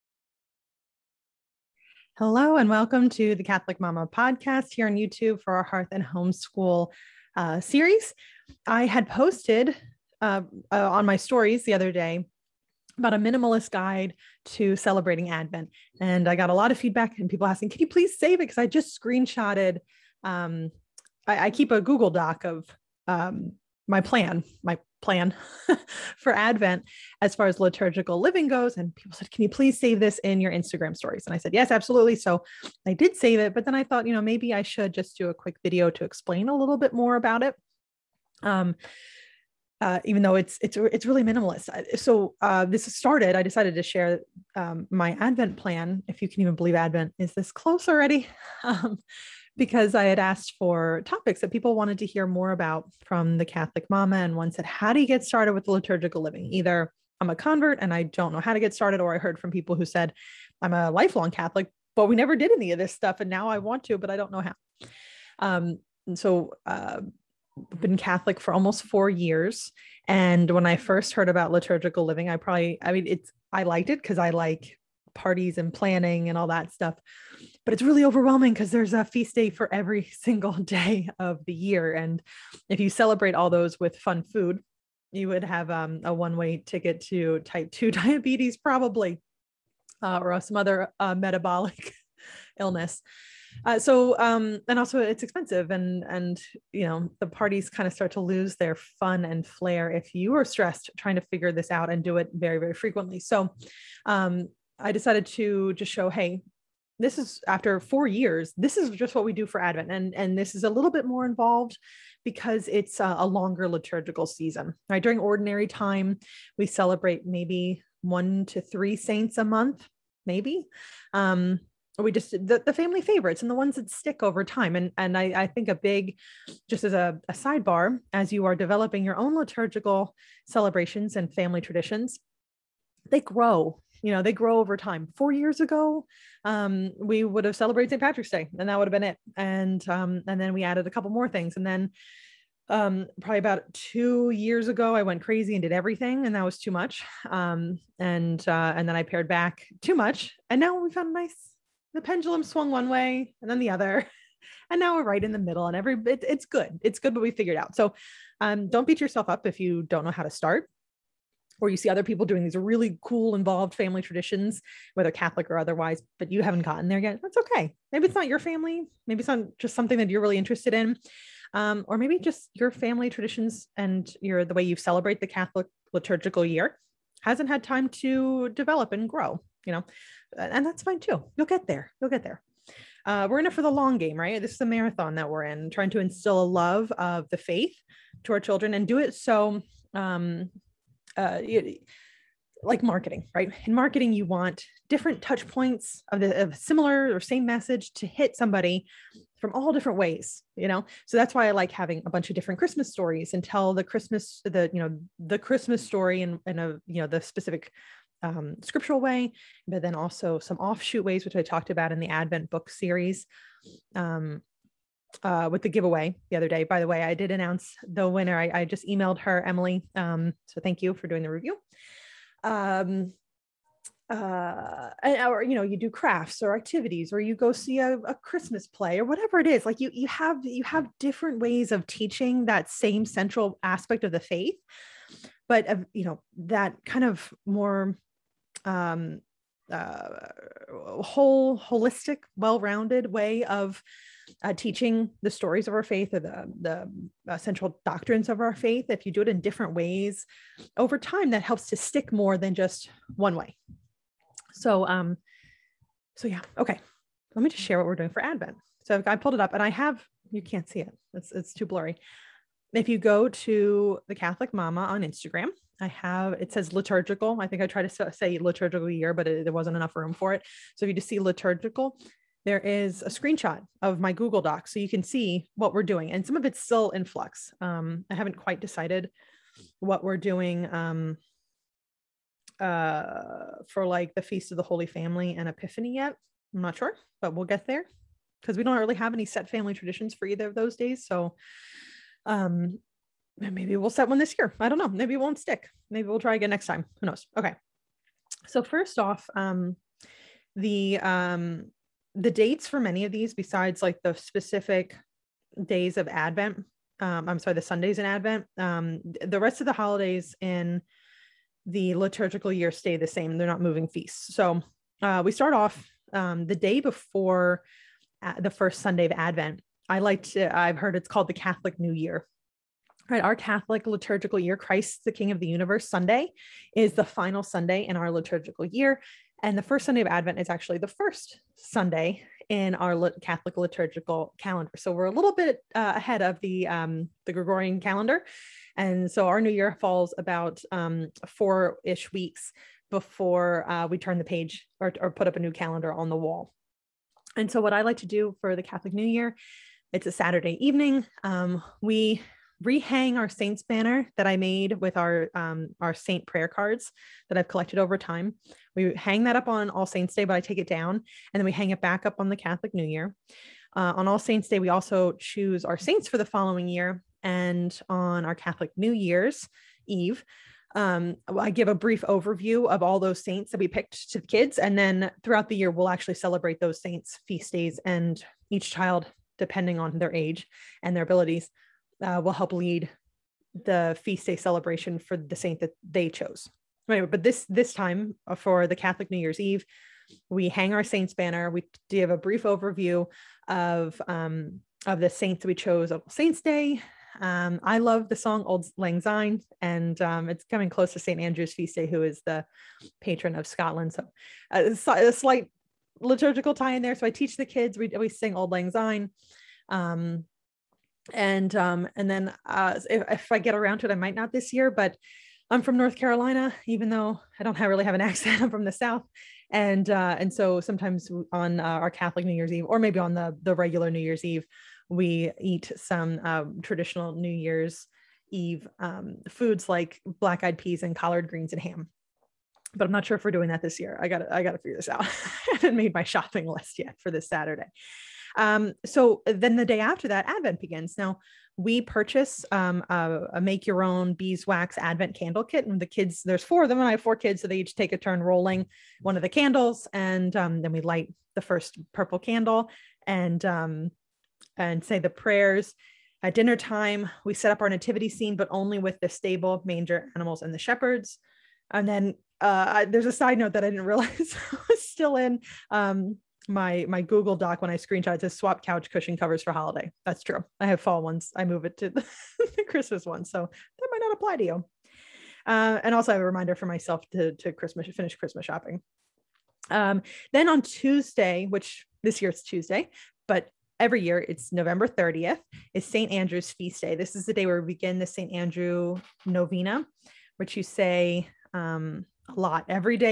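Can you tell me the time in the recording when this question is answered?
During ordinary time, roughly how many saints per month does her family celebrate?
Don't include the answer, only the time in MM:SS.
01:58.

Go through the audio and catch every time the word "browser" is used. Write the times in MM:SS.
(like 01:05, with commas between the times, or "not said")
not said.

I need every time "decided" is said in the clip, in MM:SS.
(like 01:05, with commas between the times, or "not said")
00:43, 01:44, 04:38.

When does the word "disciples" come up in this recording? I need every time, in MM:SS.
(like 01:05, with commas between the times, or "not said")
not said.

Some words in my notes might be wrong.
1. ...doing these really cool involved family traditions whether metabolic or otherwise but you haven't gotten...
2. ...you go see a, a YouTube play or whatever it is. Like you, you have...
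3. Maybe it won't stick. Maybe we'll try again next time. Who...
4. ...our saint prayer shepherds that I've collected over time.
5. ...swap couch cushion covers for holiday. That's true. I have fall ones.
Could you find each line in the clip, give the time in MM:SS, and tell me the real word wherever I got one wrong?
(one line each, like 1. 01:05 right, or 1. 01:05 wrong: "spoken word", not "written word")
1. 02:42 wrong: "catholic", not "metabolic"
2. 03:47 wrong: "Christmas", not "YouTube"
3. 04:54 right
4. 05:55 wrong: "cards", not "shepherds"
5. 07:48 right.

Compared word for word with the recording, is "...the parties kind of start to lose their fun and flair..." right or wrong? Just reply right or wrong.
right.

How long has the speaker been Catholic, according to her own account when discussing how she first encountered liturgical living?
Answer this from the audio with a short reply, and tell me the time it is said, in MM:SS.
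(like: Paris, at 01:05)
almost 4 years, at 01:08.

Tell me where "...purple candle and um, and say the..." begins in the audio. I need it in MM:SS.
07:31.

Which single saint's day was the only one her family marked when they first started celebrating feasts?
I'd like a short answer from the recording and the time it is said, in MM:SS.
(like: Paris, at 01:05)
St Patrick's Day, at 02:17.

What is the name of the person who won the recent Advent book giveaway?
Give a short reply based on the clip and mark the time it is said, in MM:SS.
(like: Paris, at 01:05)
Emily, at 03:39.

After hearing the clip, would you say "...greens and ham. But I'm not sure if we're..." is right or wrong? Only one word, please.
right.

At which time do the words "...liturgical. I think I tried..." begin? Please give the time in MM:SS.
04:26.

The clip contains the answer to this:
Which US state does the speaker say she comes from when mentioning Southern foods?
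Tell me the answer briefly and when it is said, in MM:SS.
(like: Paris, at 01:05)
North Carolina, at 06:55.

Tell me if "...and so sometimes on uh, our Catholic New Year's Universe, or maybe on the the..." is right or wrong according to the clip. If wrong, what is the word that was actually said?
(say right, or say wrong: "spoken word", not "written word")
wrong: "Eve", not "Universe".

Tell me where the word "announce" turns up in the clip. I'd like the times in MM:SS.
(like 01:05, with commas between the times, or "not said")
03:37.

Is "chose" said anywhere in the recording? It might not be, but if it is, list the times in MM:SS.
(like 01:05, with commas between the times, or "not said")
06:26, 06:35.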